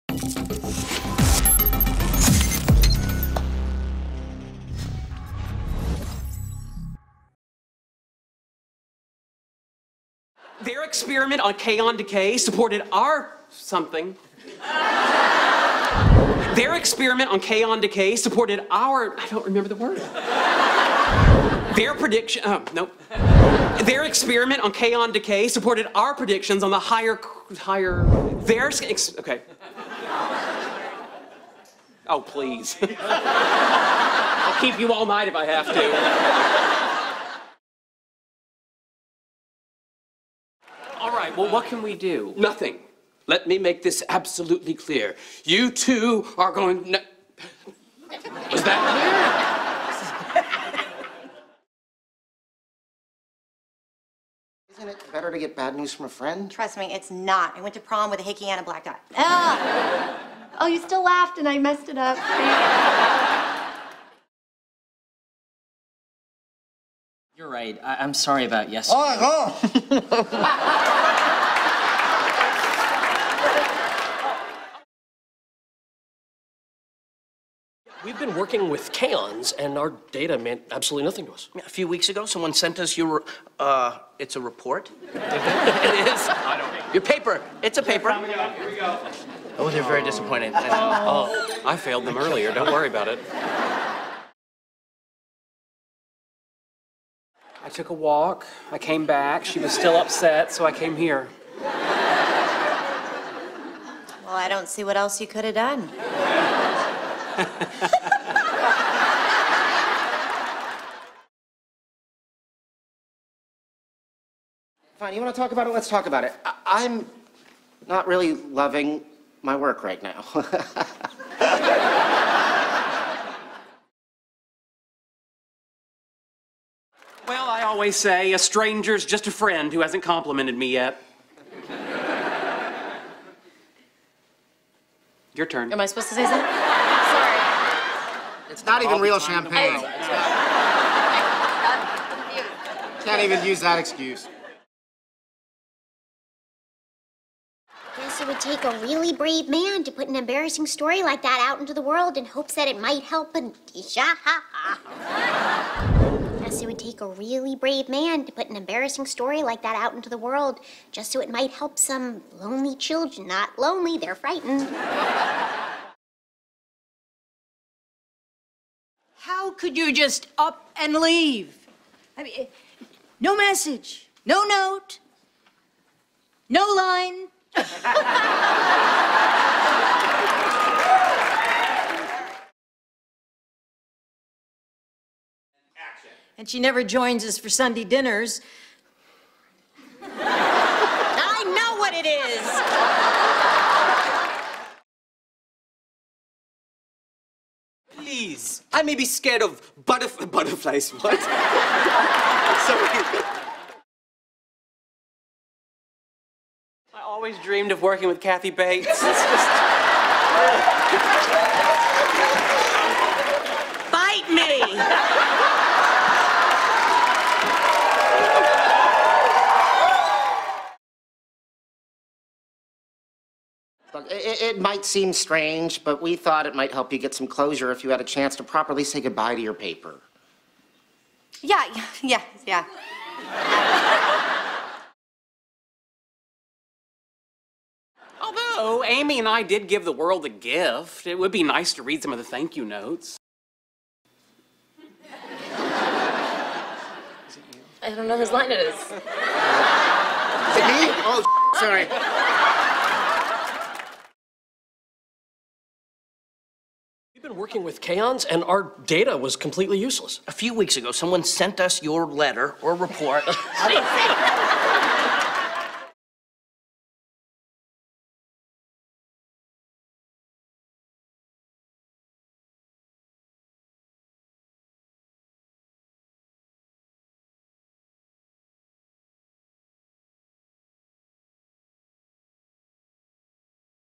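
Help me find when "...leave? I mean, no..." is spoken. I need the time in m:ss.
2:50.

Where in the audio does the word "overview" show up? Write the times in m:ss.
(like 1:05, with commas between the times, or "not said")
not said.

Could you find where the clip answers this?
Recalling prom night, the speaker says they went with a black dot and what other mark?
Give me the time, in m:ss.
0:58.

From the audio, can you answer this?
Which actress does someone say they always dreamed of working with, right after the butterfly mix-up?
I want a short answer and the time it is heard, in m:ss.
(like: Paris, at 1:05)
Kathy Bates, at 3:28.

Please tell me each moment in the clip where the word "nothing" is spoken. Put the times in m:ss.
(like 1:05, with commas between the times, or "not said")
0:42, 1:21.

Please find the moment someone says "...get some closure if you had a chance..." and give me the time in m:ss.
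3:46.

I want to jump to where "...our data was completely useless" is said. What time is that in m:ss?
4:18.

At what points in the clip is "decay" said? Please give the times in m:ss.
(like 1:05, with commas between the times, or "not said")
0:11, 0:17, 0:25.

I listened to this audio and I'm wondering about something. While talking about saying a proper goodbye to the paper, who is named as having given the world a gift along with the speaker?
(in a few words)
Amy.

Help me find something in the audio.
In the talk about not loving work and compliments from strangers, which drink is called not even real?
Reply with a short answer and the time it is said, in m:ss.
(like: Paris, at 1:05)
champagne, at 2:19.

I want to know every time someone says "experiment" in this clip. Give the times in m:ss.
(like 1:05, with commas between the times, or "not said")
0:10, 0:16, 0:24.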